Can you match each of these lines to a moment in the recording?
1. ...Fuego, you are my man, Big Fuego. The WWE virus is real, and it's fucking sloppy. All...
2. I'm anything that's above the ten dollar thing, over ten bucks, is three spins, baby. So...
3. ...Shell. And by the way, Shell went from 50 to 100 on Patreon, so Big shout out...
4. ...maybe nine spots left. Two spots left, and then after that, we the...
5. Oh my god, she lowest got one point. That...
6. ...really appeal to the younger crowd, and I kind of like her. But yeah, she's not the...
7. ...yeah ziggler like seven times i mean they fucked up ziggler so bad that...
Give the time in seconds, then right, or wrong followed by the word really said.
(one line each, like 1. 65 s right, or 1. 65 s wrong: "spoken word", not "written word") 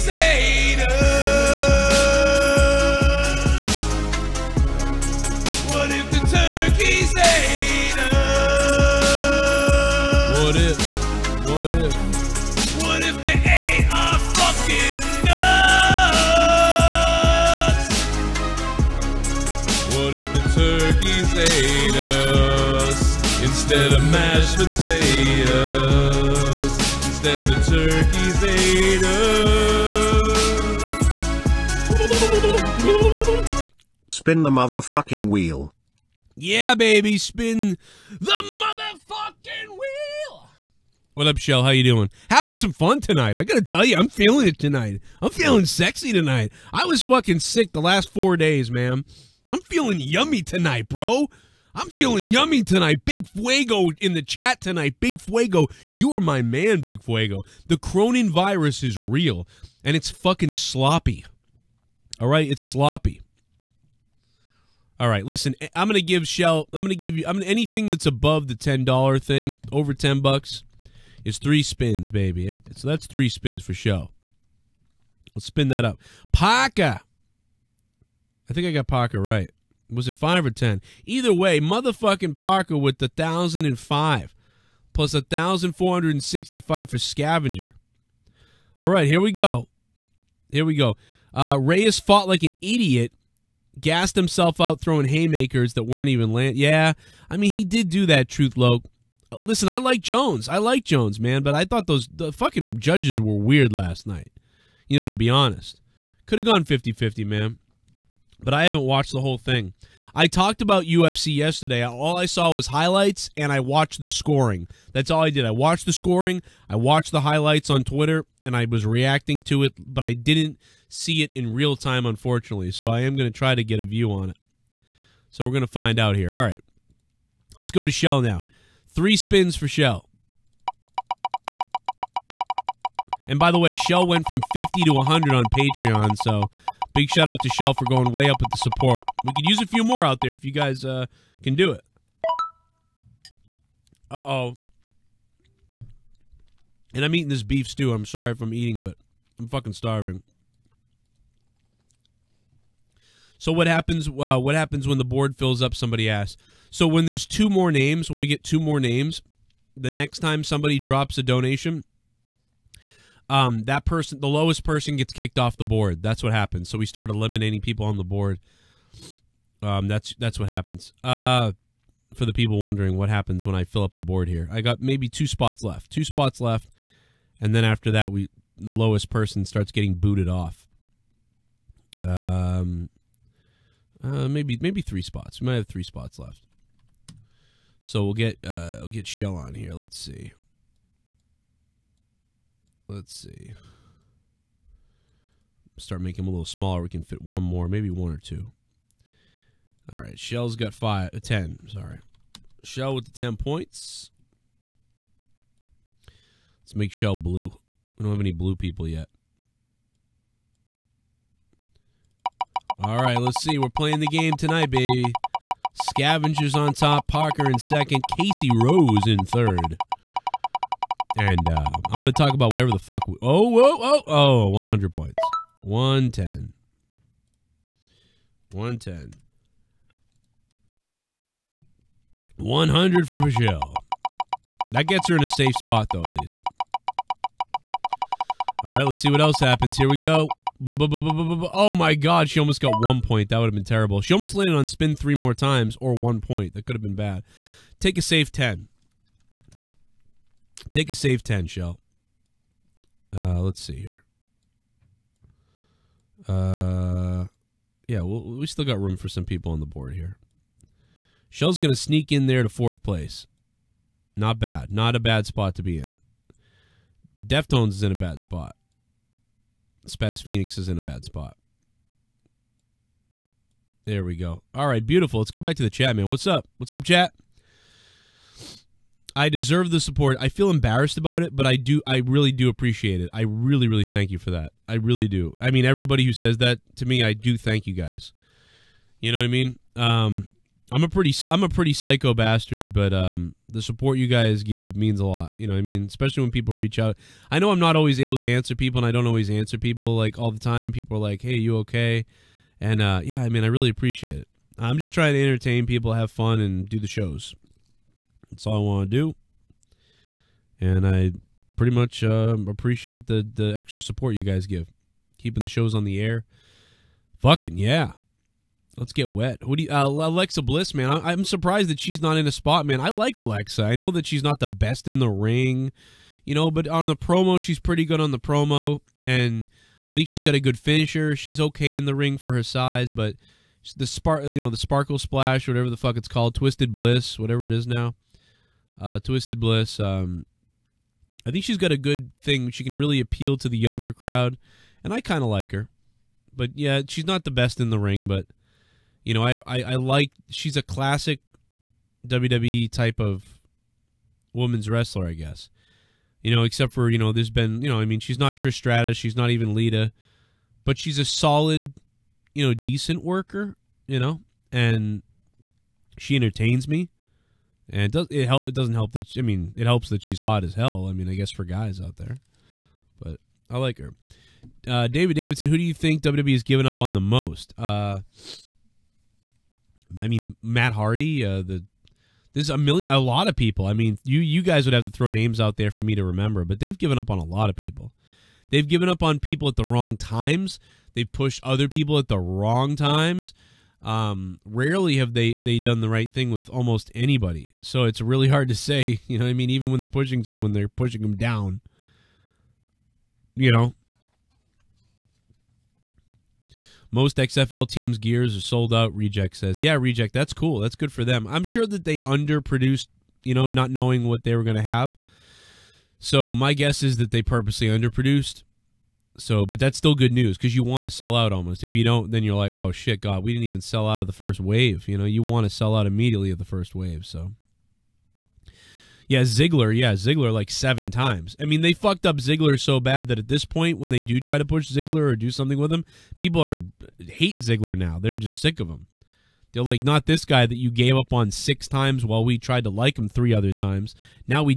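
1. 55 s wrong: "Cronin", not "WWE"
2. 67 s right
3. 129 s right
4. 174 s wrong: "two", not "nine"
5. 240 s wrong: "almost", not "lowest"
6. 342 s right
7. 429 s right.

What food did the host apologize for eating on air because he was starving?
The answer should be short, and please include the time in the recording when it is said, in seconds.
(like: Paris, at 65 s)
Beef stew, at 147 s.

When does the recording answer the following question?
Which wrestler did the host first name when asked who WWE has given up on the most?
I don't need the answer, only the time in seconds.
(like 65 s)
380 s.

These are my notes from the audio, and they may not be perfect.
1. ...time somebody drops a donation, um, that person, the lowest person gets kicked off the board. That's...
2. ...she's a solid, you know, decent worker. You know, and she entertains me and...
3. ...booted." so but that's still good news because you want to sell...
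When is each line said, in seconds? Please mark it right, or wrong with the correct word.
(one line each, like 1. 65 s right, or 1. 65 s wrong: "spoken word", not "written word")
1. 160 s right
2. 360 s right
3. 417 s wrong: "underproduced", not "booted".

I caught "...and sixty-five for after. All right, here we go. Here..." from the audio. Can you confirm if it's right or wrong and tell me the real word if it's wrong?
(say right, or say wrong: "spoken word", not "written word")
wrong: "scavenger", not "after".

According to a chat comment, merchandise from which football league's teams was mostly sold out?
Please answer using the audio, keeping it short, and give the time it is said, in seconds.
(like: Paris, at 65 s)
XFL, at 407 s.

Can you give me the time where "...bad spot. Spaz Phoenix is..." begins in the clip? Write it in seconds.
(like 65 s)
267 s.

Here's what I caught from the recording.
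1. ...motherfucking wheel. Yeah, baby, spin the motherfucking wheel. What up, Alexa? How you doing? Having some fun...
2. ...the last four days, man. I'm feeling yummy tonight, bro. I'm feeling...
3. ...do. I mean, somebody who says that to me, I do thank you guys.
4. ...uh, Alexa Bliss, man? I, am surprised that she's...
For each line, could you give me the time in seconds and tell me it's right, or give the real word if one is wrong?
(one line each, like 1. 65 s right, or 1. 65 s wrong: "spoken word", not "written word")
1. 34 s wrong: "Shell", not "Alexa"
2. 47 s right
3. 285 s wrong: "everybody", not "somebody"
4. 319 s right.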